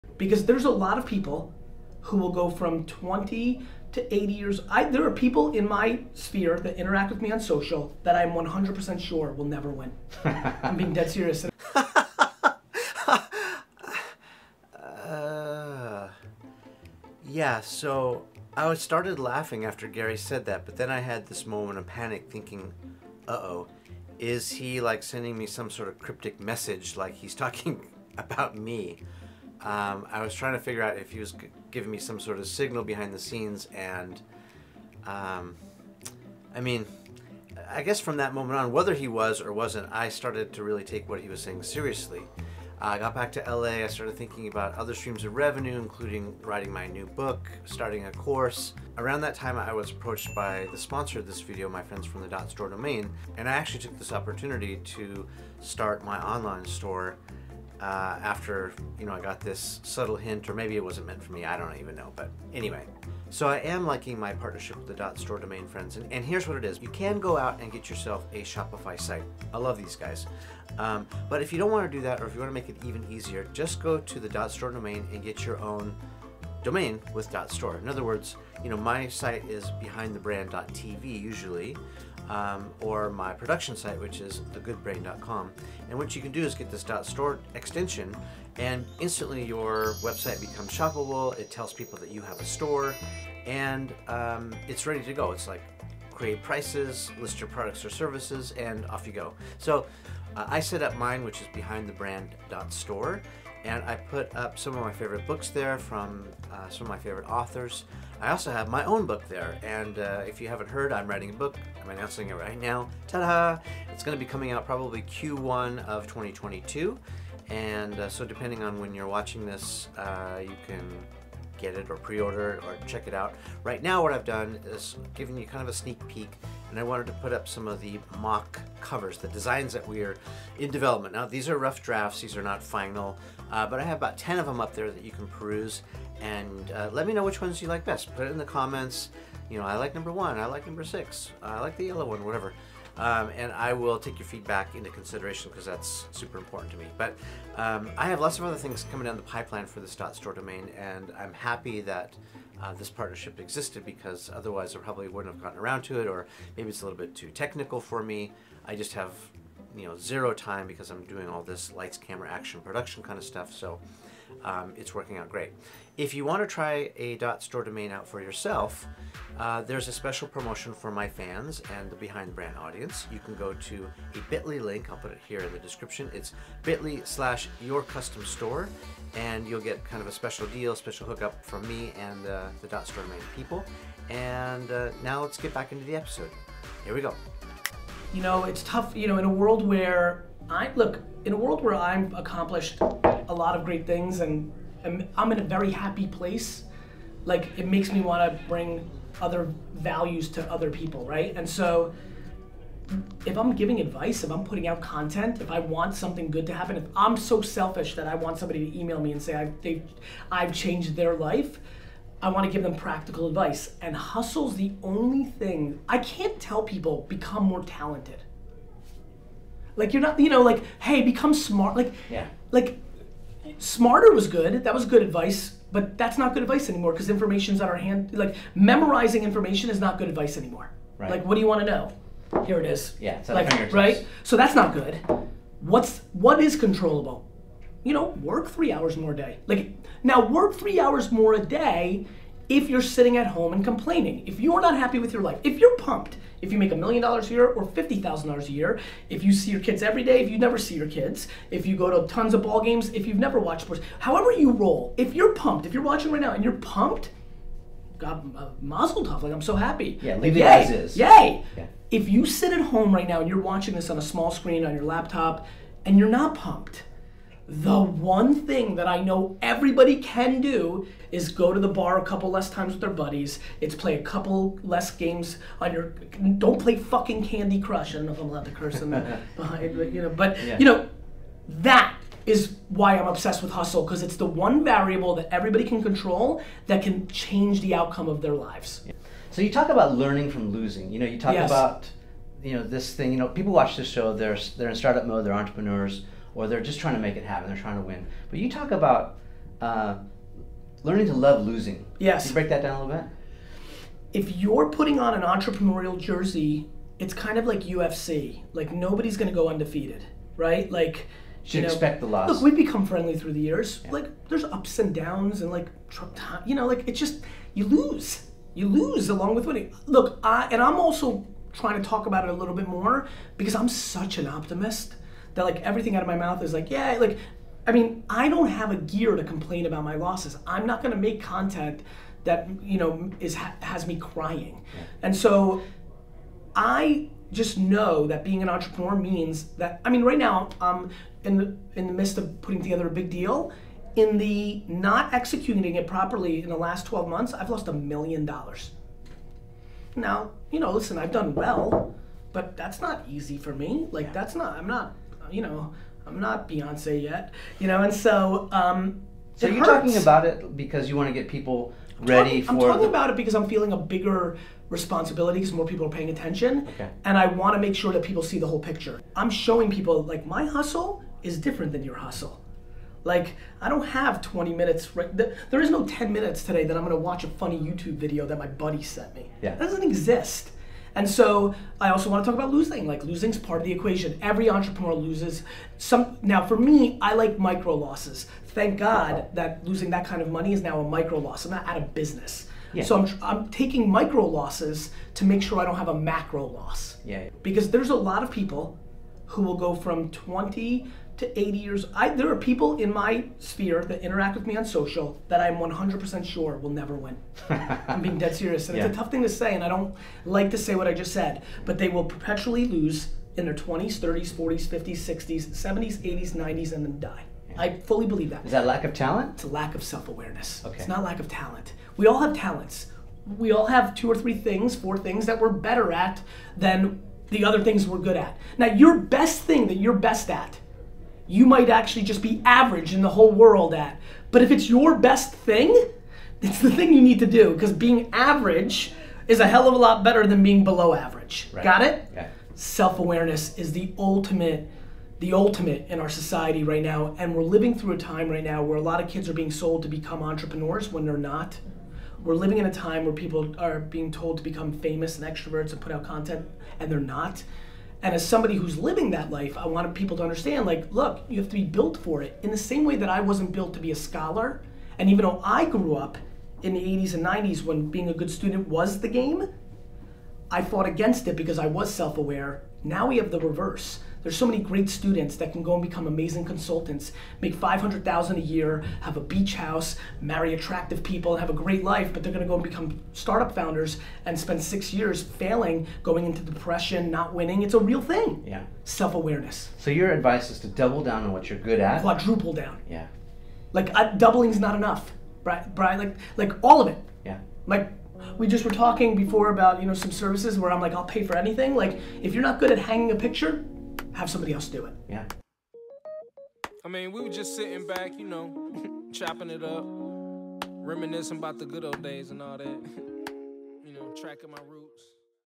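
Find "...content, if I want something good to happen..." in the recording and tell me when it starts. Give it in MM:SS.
03:24.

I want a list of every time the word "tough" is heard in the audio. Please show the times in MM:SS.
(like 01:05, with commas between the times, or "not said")
03:08, 06:48.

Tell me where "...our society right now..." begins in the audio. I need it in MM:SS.
07:25.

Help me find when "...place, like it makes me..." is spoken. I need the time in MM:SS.
03:16.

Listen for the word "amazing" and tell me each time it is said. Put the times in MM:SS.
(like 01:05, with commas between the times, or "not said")
07:56.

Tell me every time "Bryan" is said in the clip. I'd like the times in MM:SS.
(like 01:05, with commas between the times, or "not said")
08:15.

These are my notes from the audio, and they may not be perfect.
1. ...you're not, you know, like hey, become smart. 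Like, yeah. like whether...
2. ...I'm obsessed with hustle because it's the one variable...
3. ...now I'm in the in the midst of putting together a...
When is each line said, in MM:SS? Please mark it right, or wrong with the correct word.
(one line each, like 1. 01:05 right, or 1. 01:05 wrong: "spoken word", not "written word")
1. 03:39 wrong: "smarter", not "whether"
2. 04:42 right
3. 05:40 right.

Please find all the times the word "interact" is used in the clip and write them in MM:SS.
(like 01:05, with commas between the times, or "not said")
00:06, 06:44.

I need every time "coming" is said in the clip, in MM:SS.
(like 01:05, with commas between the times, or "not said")
01:54, 02:28.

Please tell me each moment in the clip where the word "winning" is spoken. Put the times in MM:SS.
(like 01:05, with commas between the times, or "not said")
05:19, 08:07.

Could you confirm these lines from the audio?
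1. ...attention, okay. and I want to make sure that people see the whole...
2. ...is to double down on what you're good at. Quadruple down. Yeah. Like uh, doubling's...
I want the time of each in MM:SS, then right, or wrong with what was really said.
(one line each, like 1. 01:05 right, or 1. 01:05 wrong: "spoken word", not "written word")
1. 06:06 right
2. 08:10 right.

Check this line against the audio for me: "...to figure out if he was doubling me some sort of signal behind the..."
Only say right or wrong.
wrong.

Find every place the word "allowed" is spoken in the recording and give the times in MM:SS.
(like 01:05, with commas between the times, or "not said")
04:38.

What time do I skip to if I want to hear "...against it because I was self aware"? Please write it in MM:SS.
07:50.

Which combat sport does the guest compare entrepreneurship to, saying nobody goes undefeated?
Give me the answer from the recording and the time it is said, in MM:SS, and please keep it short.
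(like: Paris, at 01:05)
UFC, at 05:07.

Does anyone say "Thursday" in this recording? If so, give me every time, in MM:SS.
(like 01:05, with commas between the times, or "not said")
not said.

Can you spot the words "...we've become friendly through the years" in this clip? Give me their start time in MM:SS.
05:12.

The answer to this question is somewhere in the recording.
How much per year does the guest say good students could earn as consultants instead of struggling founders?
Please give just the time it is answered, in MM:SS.
07:57.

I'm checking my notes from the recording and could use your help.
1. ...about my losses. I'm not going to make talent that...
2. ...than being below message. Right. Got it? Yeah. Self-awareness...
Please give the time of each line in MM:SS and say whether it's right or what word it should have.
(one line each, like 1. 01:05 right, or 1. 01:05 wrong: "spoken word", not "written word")
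1. 05:29 wrong: "content", not "talent"
2. 07:20 wrong: "average", not "message".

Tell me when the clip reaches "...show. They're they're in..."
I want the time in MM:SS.
04:53.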